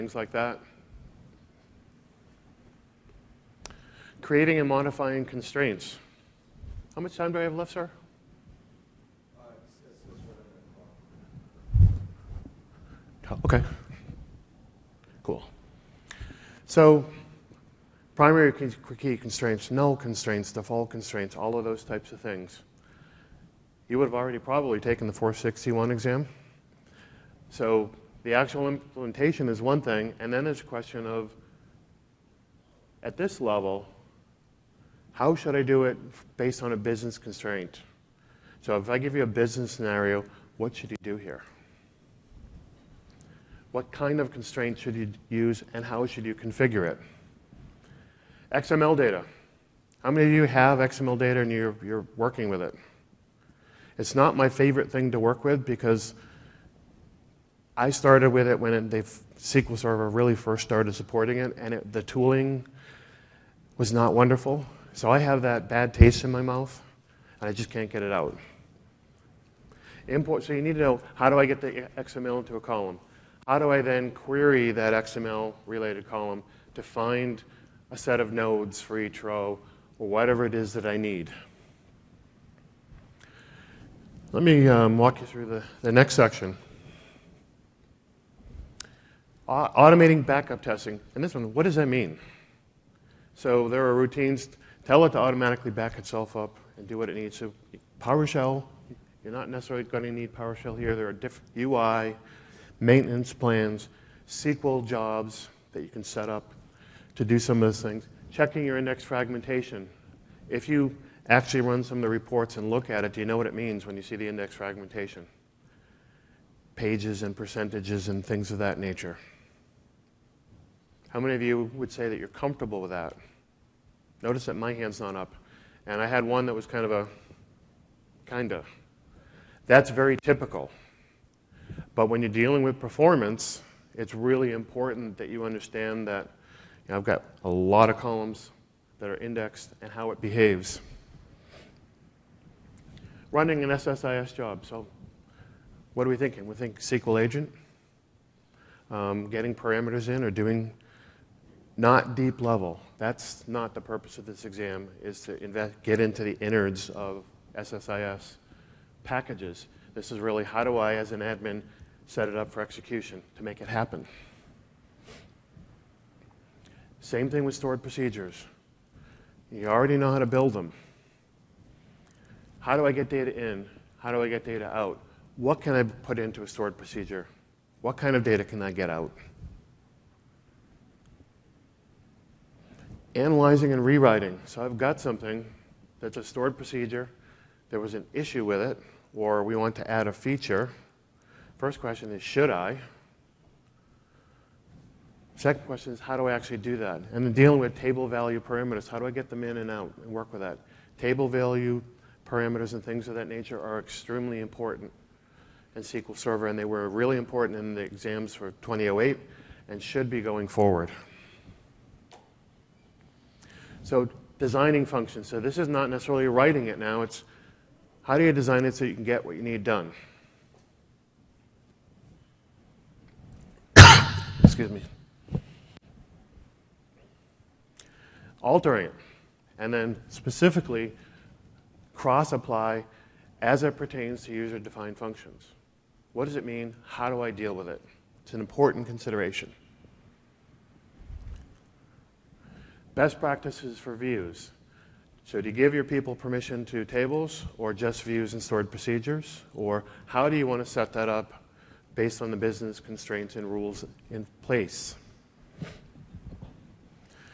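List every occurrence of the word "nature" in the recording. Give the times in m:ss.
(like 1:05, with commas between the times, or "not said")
1:58, 3:23.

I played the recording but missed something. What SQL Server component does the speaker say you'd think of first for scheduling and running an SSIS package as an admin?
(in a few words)
SQL agent.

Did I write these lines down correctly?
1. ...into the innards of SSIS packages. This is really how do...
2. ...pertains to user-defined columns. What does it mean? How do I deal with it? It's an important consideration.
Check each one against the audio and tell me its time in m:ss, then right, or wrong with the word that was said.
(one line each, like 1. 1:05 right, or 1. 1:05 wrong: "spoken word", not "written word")
1. 2:35 right
2. 3:53 wrong: "functions", not "columns".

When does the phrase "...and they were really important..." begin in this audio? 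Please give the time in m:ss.
3:26.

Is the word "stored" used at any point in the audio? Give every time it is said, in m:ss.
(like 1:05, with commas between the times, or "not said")
2:47, 2:56, 3:06, 4:08.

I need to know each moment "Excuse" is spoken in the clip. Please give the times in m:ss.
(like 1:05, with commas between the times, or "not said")
3:44.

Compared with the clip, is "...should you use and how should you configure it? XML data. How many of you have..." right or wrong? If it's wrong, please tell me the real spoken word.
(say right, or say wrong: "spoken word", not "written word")
right.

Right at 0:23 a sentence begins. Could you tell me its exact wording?
You would have already probably taken the 461 exam.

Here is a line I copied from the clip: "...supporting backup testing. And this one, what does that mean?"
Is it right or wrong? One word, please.
wrong.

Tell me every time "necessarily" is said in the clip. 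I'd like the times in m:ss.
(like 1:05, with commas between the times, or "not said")
1:39, 3:35.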